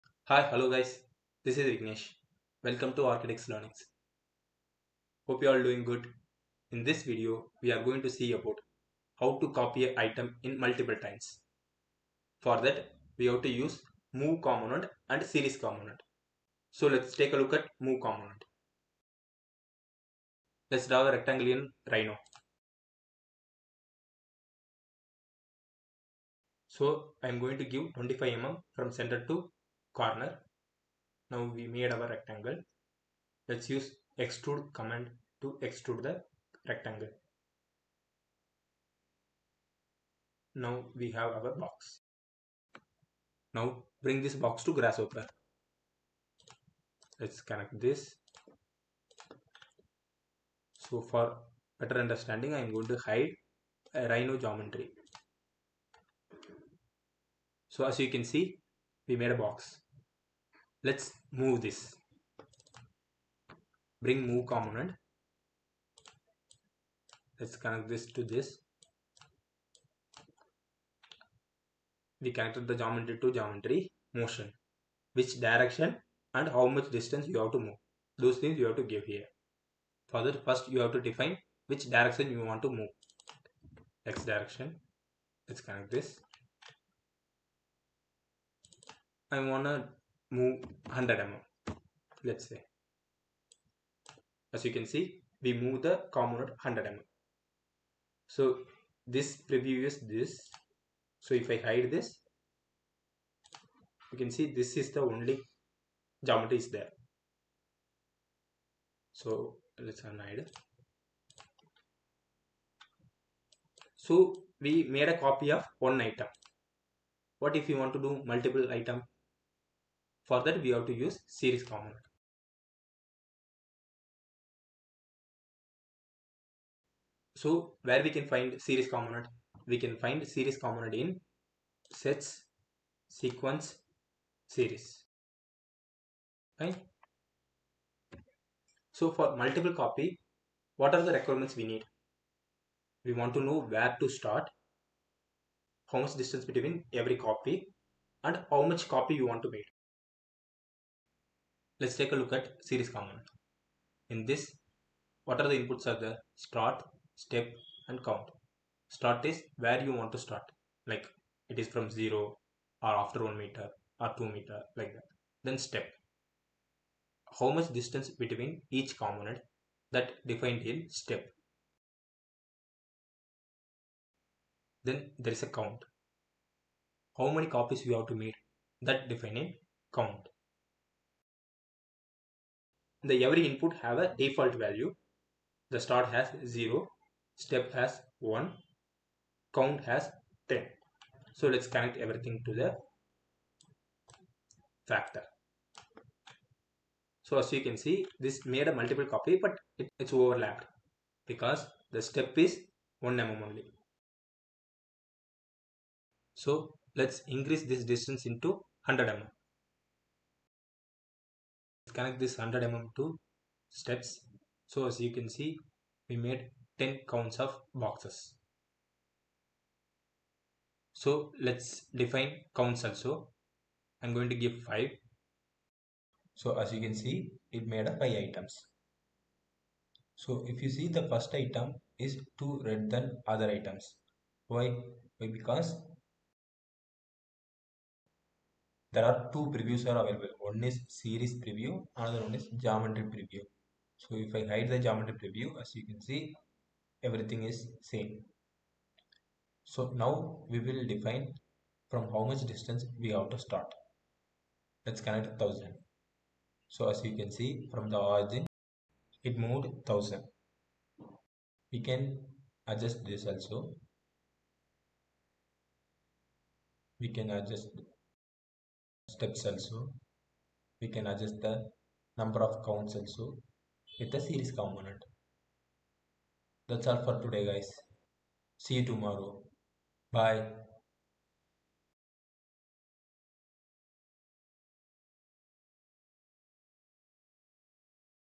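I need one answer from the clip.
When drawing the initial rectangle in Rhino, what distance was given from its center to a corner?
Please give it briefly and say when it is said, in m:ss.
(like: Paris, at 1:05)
25 mm, at 0:27.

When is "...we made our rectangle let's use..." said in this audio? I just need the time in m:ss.
0:31.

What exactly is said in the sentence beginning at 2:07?
So where we can find series component?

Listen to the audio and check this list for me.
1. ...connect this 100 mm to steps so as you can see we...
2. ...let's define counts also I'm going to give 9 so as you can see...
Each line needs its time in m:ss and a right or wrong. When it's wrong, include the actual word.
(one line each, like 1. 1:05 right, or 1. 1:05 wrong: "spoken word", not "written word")
1. 3:31 right
2. 3:41 wrong: "5", not "9".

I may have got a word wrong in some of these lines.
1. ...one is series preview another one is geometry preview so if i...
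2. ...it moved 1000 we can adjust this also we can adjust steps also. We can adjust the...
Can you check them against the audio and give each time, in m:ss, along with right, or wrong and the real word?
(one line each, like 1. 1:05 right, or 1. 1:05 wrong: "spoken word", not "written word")
1. 4:00 right
2. 4:19 right.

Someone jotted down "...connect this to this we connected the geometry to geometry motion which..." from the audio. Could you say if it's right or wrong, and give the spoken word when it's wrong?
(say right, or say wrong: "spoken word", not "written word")
right.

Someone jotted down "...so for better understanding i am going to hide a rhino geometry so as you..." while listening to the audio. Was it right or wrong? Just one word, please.
right.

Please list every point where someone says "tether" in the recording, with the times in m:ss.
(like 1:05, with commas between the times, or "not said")
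not said.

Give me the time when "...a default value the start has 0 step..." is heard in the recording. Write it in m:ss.
3:03.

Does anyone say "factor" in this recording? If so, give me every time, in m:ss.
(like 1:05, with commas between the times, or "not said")
3:14.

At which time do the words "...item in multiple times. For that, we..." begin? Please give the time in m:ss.
0:10.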